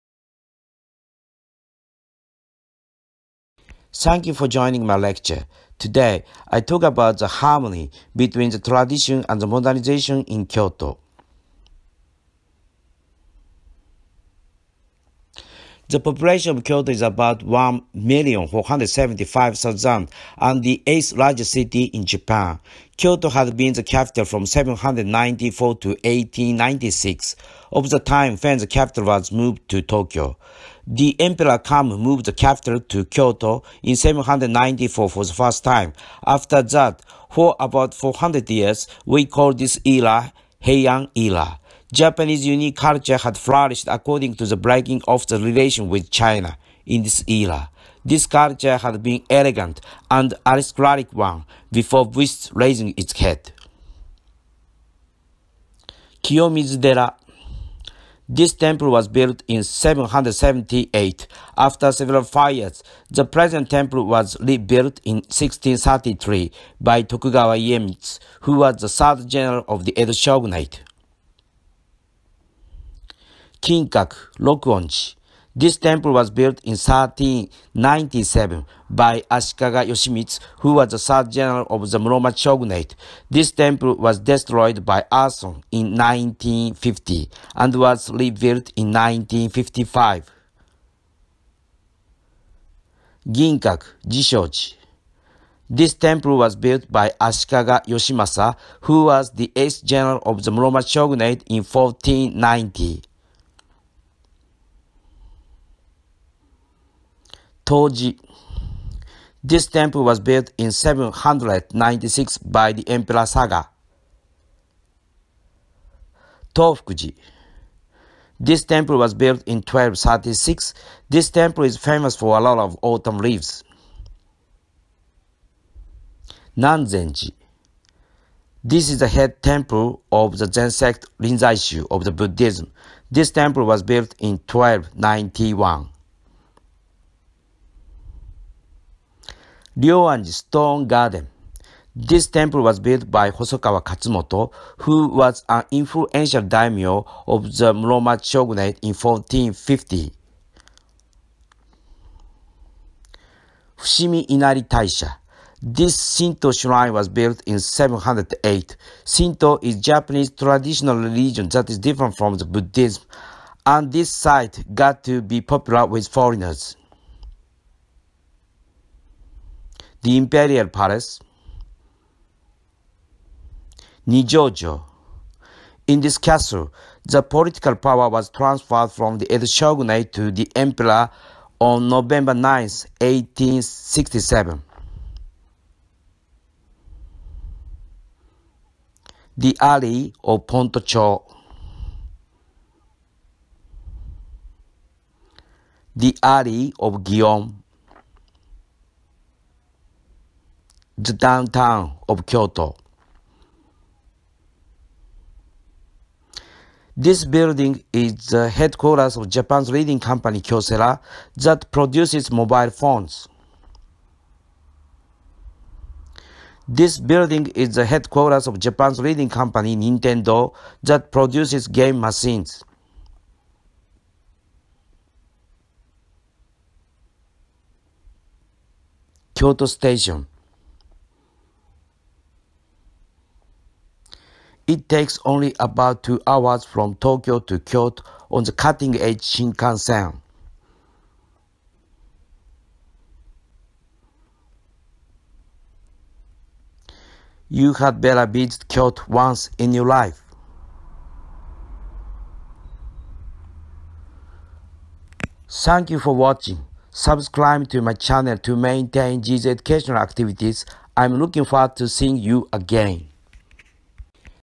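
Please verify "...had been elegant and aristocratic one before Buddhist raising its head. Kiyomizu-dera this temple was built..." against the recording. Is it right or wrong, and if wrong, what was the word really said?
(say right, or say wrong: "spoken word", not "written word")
right.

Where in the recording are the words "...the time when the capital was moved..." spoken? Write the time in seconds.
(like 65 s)
27 s.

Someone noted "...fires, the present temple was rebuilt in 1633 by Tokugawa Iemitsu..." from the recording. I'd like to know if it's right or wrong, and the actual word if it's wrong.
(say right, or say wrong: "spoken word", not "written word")
right.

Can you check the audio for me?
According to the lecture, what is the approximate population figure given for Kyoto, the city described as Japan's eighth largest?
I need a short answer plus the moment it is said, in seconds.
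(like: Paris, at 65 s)
1,475,000, at 17 s.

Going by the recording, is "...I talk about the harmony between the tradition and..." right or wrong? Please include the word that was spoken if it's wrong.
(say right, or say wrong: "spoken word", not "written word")
right.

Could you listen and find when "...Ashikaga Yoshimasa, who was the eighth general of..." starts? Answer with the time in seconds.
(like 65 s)
97 s.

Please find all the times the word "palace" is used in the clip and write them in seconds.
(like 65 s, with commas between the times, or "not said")
170 s.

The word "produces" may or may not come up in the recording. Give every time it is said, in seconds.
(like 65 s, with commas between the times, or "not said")
211 s, 221 s.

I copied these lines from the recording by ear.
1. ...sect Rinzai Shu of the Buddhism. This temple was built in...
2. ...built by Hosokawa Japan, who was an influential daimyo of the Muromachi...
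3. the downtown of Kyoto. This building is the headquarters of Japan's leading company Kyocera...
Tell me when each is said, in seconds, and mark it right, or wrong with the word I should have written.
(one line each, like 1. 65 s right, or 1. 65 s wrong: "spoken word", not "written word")
1. 130 s right
2. 142 s wrong: "Katsumoto", not "Japan"
3. 201 s right.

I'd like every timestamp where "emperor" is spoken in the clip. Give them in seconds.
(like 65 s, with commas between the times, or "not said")
31 s, 112 s, 180 s.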